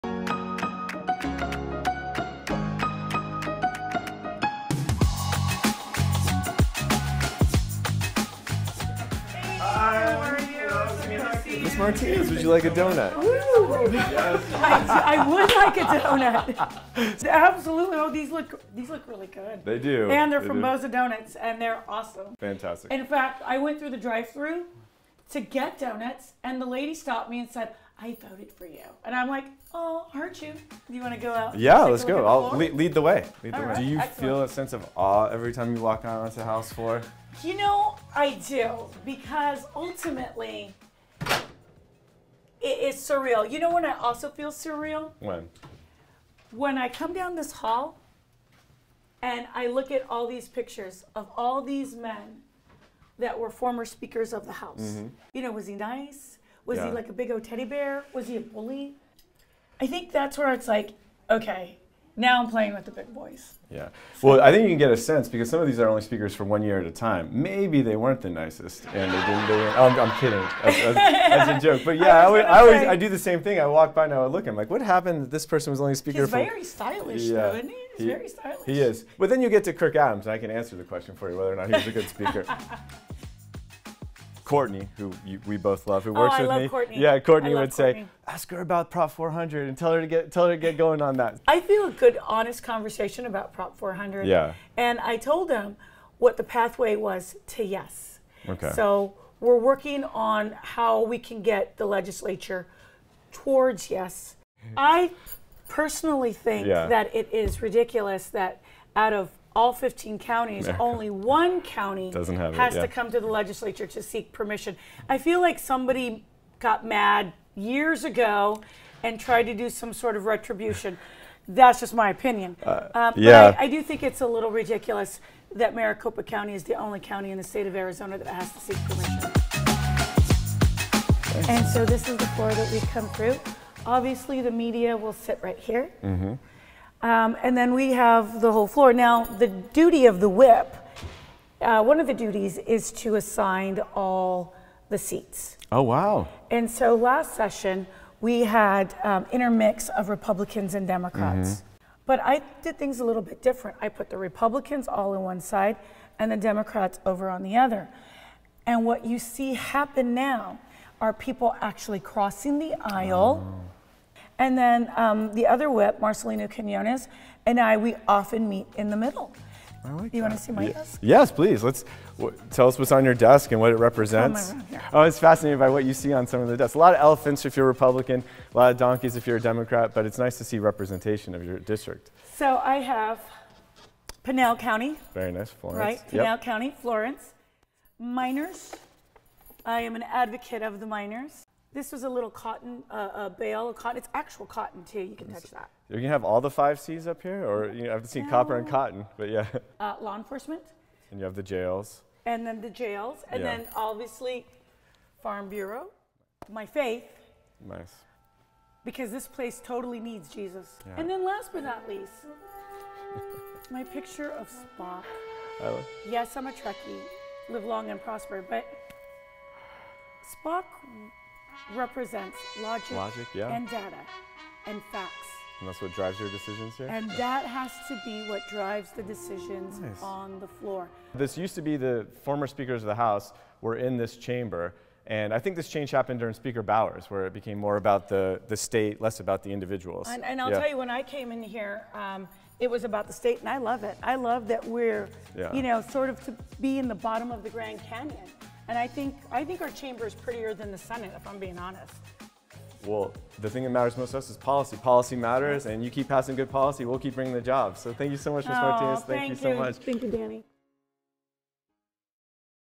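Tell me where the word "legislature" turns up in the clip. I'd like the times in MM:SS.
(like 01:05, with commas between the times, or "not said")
01:41, 01:53.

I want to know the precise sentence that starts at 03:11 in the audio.
This was a little cotton uh, uh, bale, cotton.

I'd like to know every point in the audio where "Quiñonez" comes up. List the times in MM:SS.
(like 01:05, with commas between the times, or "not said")
02:46.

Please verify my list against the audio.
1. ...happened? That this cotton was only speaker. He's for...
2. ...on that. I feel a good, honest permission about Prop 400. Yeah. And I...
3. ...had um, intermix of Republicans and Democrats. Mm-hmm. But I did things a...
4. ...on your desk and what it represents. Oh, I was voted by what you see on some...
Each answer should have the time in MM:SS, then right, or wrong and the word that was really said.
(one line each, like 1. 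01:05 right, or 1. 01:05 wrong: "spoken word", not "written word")
1. 01:14 wrong: "person", not "cotton"
2. 01:31 wrong: "conversation", not "permission"
3. 02:28 right
4. 02:52 wrong: "fascinated", not "voted".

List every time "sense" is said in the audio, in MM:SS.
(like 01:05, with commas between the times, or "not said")
00:34, 01:04.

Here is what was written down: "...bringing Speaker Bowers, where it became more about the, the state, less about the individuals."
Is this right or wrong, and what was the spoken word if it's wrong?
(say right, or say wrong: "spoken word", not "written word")
wrong: "during", not "bringing".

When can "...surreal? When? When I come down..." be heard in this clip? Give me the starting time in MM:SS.
00:44.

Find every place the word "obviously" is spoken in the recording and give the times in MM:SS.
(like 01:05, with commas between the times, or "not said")
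02:13, 03:23.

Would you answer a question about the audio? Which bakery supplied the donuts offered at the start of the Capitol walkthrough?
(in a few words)
Bosa Donuts.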